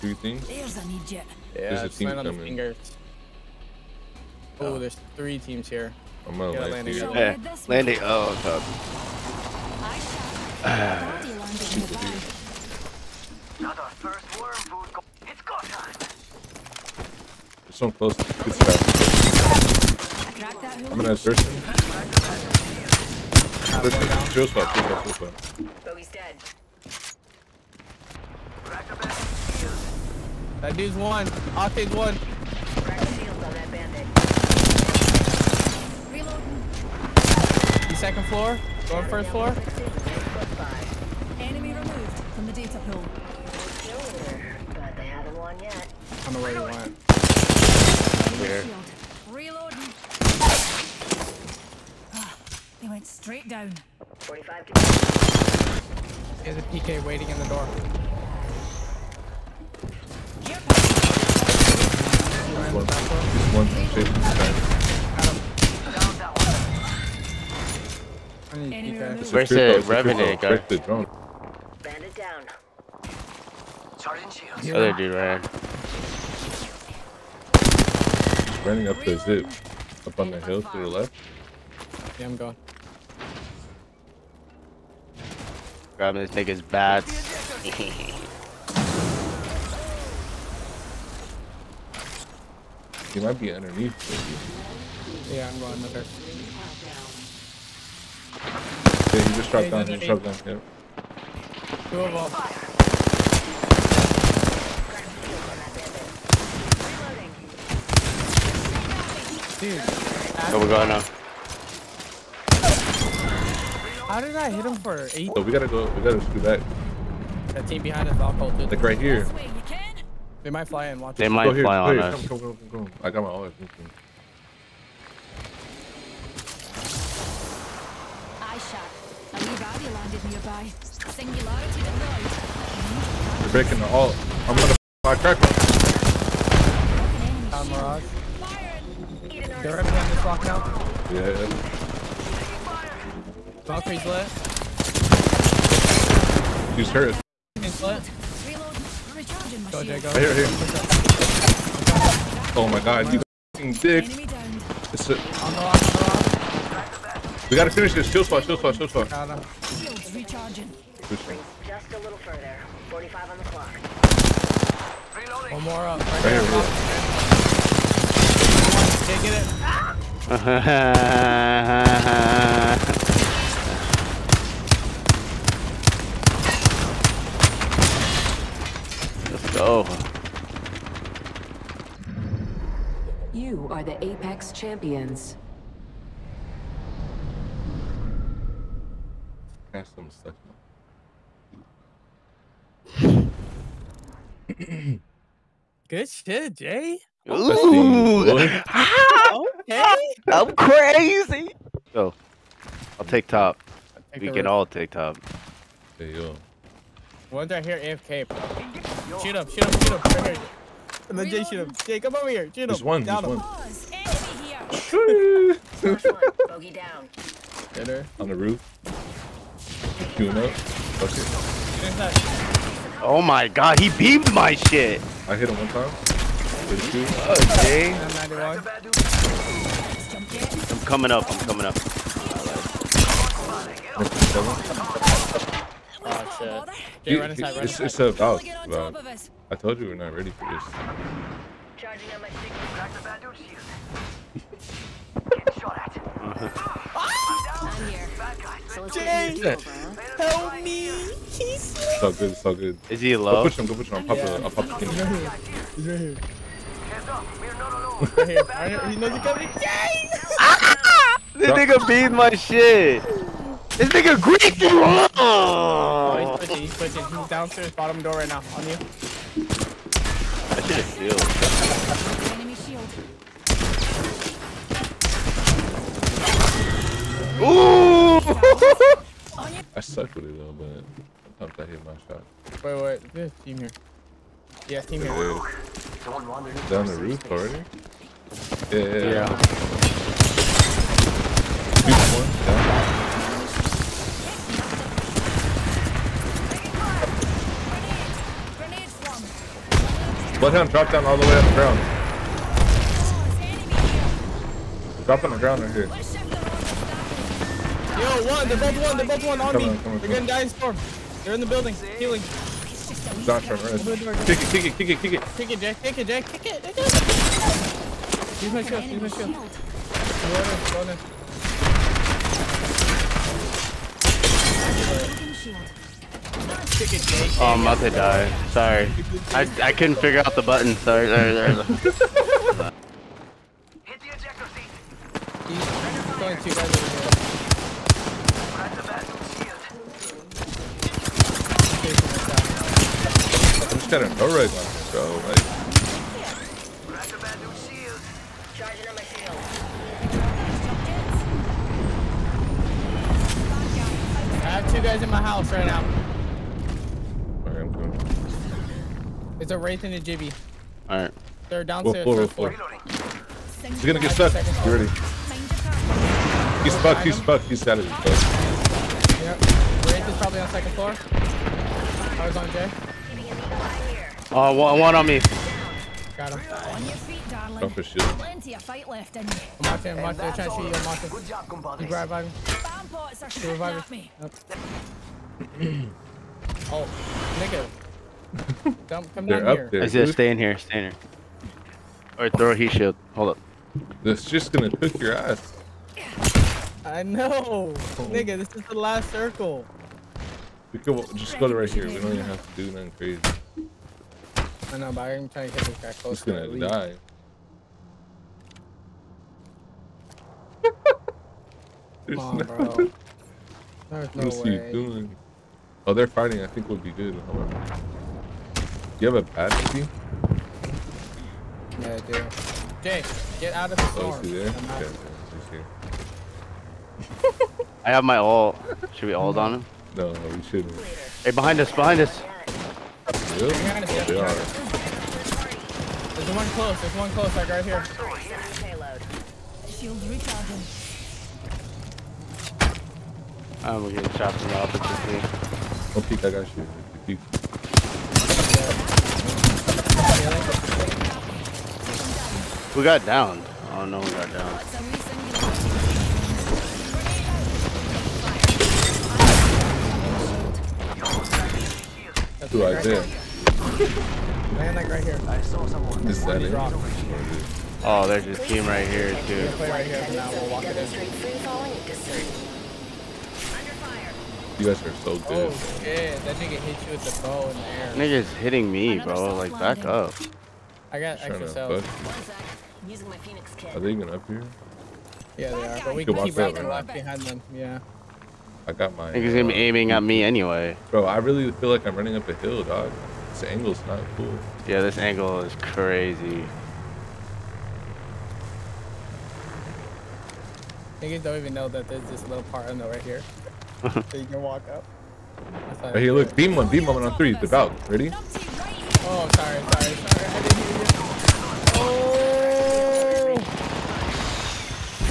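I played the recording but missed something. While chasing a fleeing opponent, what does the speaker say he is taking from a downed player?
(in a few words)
bats.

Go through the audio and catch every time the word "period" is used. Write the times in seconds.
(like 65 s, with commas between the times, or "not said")
not said.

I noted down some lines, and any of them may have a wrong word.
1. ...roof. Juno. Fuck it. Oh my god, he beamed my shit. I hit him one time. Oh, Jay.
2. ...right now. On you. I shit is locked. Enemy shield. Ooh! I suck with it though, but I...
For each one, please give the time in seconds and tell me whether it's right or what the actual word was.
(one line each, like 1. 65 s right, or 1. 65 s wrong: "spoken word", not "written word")
1. 218 s right
2. 268 s wrong: "sealed", not "locked".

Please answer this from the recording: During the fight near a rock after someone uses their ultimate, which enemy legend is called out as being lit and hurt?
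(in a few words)
Valkyrie.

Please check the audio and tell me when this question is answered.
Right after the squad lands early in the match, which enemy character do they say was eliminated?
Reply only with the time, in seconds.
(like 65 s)
25 s.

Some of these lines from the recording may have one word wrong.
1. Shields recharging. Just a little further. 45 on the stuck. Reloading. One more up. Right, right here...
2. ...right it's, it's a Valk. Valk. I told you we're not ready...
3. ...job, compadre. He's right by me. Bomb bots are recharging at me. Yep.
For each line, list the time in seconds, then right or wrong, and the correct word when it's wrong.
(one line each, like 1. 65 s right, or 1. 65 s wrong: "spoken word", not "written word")
1. 159 s wrong: "clock", not "stuck"
2. 237 s right
3. 381 s wrong: "shooting", not "recharging".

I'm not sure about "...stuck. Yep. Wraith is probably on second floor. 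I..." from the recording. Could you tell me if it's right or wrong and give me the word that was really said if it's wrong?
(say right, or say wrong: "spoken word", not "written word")
right.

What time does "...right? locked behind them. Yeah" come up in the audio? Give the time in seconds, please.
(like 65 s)
486 s.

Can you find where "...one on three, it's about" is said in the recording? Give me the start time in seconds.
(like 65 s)
506 s.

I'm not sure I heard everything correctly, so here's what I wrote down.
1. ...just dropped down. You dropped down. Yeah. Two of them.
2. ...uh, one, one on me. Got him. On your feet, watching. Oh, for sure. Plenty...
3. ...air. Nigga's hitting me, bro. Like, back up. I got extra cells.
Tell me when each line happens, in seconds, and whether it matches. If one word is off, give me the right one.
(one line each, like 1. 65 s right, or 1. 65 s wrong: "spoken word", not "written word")
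1. 99 s right
2. 374 s wrong: "darling", not "watching"
3. 478 s right.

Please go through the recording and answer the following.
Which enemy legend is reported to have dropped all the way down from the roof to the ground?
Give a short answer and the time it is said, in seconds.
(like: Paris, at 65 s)
Bloodhound, at 300 s.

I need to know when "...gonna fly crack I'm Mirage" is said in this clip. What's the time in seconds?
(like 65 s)
134 s.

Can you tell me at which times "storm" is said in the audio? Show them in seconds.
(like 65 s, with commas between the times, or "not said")
310 s, 423 s.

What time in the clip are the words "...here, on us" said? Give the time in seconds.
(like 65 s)
121 s.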